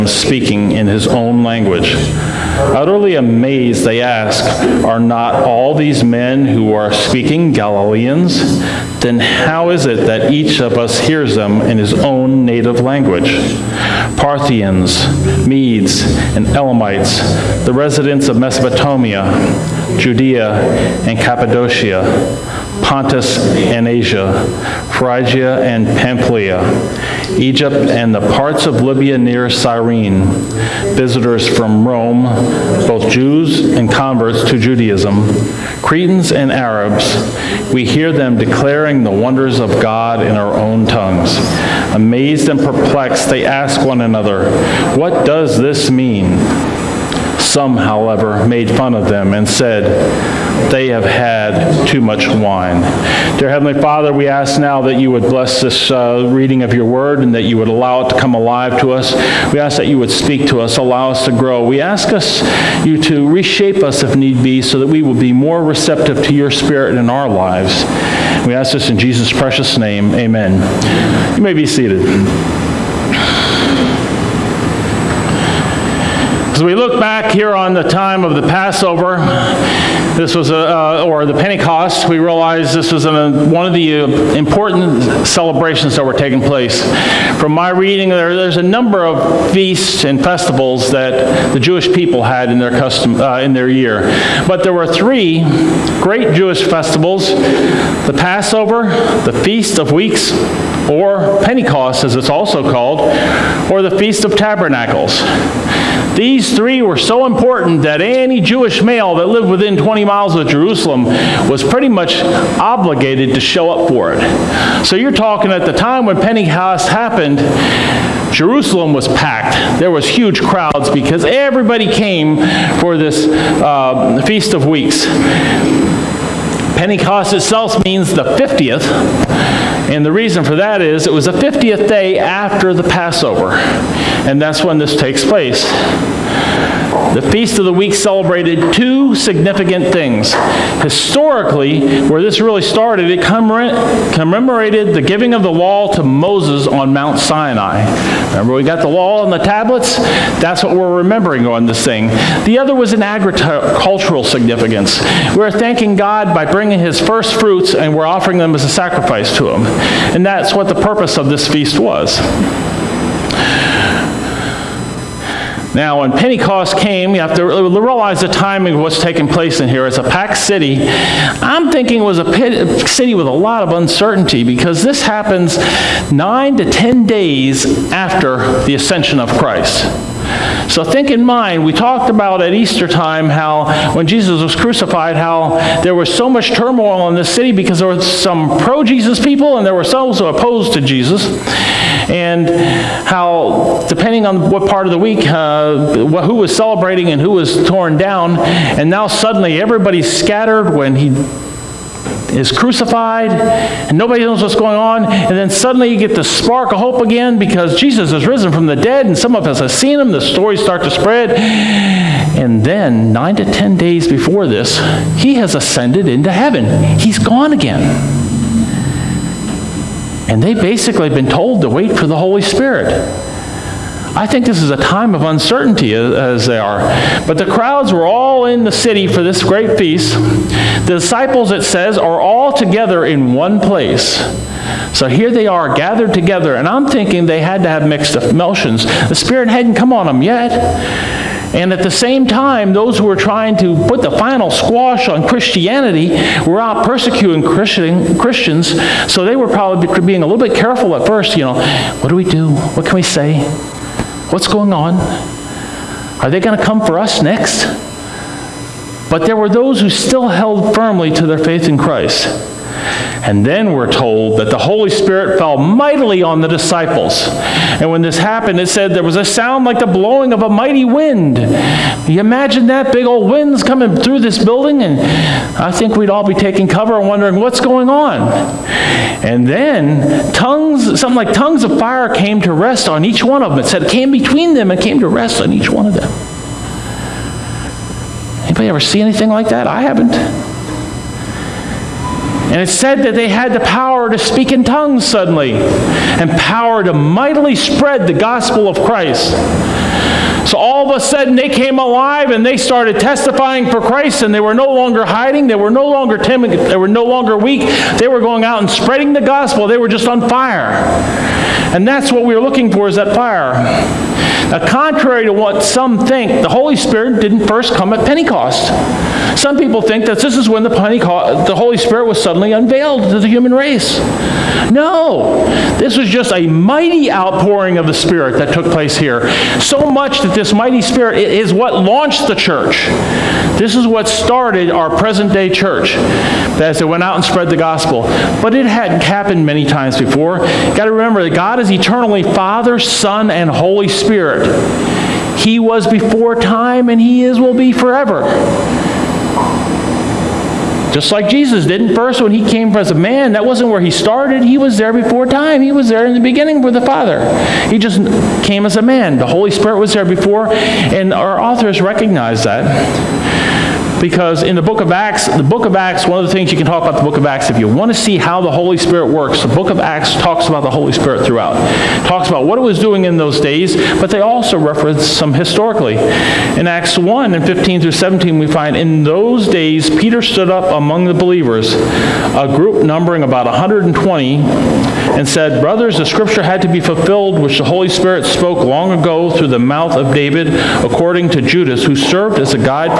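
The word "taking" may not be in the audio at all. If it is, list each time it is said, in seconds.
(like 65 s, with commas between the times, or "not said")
86 s, 169 s, 276 s.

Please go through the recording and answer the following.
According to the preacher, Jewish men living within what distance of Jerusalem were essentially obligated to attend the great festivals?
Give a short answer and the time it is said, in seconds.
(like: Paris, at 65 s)
20 miles, at 109 s.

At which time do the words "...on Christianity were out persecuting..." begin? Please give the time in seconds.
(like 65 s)
245 s.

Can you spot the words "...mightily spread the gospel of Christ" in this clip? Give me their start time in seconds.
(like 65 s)
296 s.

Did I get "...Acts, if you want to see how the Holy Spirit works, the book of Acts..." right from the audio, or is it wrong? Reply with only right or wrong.
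right.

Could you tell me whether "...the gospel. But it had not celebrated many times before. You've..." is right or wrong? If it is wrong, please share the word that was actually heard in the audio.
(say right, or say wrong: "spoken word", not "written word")
wrong: "happened", not "celebrated".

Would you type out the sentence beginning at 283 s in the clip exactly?
It said it came between them and came to rest on each one of them.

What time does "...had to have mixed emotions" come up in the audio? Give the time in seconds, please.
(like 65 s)
237 s.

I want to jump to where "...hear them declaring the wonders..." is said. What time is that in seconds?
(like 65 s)
37 s.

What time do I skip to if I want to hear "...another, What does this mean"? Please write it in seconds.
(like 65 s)
44 s.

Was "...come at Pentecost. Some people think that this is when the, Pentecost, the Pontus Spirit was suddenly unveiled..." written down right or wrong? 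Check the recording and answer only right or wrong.
wrong.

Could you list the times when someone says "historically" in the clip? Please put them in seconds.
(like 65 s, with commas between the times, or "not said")
140 s, 375 s.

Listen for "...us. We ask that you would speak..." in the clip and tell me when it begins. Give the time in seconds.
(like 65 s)
58 s.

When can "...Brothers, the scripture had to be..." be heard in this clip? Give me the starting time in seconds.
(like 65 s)
385 s.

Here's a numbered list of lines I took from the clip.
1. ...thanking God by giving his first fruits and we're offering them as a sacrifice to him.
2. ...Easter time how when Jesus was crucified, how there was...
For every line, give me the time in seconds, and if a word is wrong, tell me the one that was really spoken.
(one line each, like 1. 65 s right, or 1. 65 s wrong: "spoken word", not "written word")
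1. 155 s wrong: "bringing", not "giving"
2. 182 s right.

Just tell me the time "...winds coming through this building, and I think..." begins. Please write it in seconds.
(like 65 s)
273 s.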